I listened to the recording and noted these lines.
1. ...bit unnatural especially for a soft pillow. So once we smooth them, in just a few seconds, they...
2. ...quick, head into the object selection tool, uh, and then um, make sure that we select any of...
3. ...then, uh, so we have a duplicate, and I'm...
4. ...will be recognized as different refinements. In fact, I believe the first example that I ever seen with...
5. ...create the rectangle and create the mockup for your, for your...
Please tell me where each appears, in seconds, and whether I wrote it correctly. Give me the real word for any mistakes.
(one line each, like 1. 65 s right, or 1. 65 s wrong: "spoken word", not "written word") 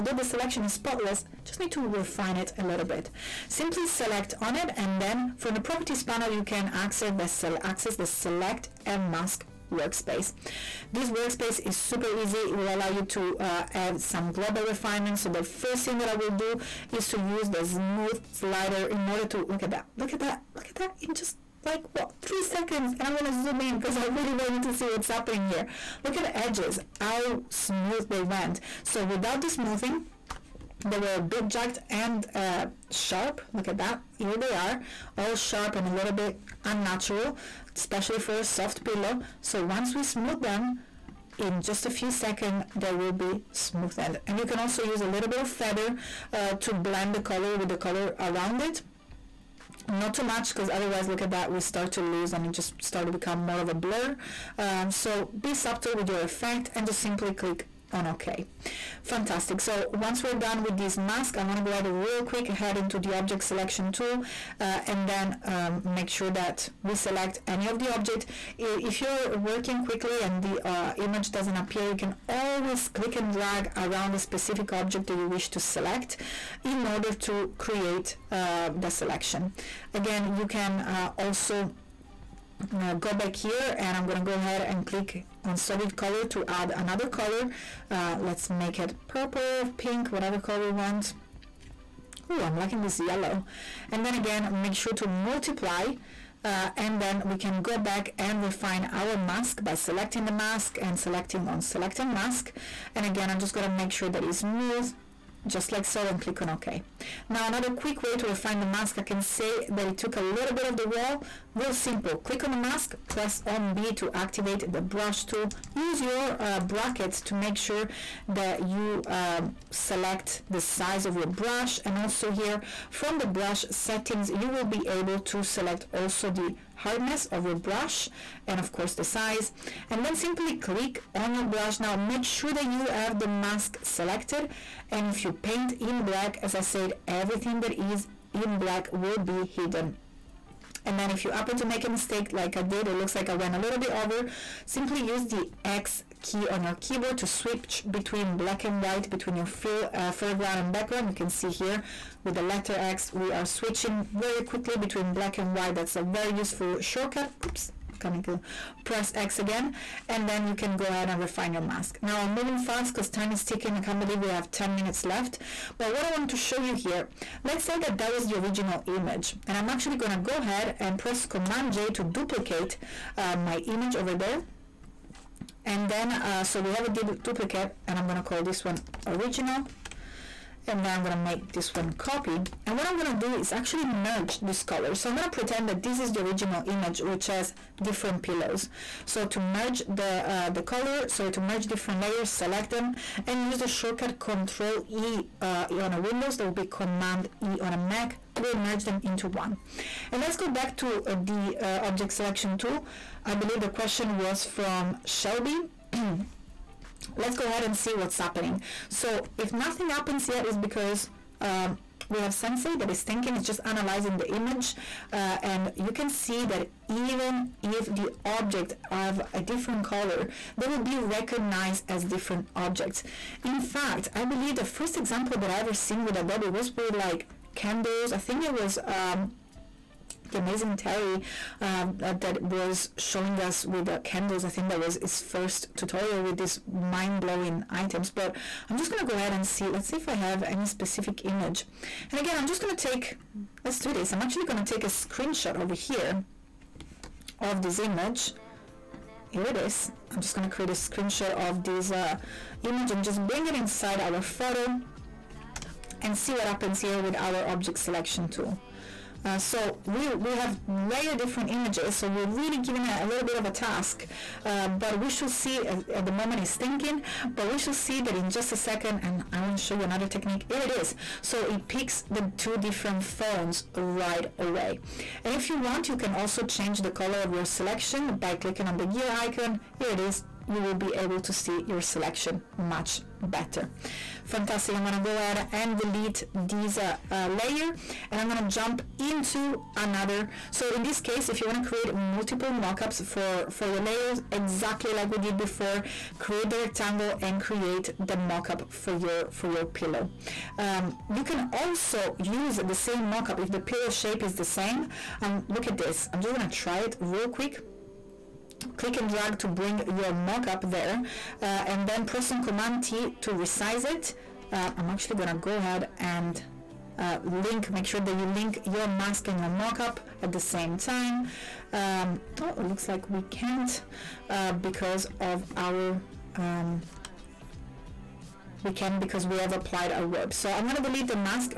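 1. 36 s right
2. 62 s right
3. 175 s right
4. 220 s wrong: "objects", not "refinements"
5. 296 s right.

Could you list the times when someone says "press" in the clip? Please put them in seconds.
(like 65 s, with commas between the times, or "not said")
113 s, 158 s, 170 s, 312 s.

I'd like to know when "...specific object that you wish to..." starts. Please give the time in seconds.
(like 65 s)
74 s.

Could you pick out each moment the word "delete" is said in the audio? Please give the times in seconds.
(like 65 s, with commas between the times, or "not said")
285 s, 330 s.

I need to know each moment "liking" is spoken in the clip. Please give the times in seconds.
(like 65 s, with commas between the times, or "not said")
92 s.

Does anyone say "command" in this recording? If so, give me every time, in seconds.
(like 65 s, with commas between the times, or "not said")
171 s, 196 s, 312 s.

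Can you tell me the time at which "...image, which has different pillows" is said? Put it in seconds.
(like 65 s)
186 s.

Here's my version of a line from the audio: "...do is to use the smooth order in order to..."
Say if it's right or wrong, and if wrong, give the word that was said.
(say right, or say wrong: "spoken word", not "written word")
wrong: "slider", not "order".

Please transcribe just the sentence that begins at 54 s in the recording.
Um, so be subtle with your effect and just simply click on OK.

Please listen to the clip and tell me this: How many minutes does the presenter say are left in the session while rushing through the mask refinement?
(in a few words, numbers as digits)
10.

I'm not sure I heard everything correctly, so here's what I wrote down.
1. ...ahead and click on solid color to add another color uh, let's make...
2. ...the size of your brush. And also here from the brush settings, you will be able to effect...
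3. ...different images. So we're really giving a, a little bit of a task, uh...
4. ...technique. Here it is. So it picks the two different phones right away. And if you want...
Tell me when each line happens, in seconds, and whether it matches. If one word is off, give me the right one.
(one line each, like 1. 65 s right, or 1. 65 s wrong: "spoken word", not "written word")
1. 84 s right
2. 120 s wrong: "select", not "effect"
3. 261 s right
4. 270 s right.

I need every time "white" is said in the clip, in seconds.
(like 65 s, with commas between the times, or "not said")
148 s, 155 s.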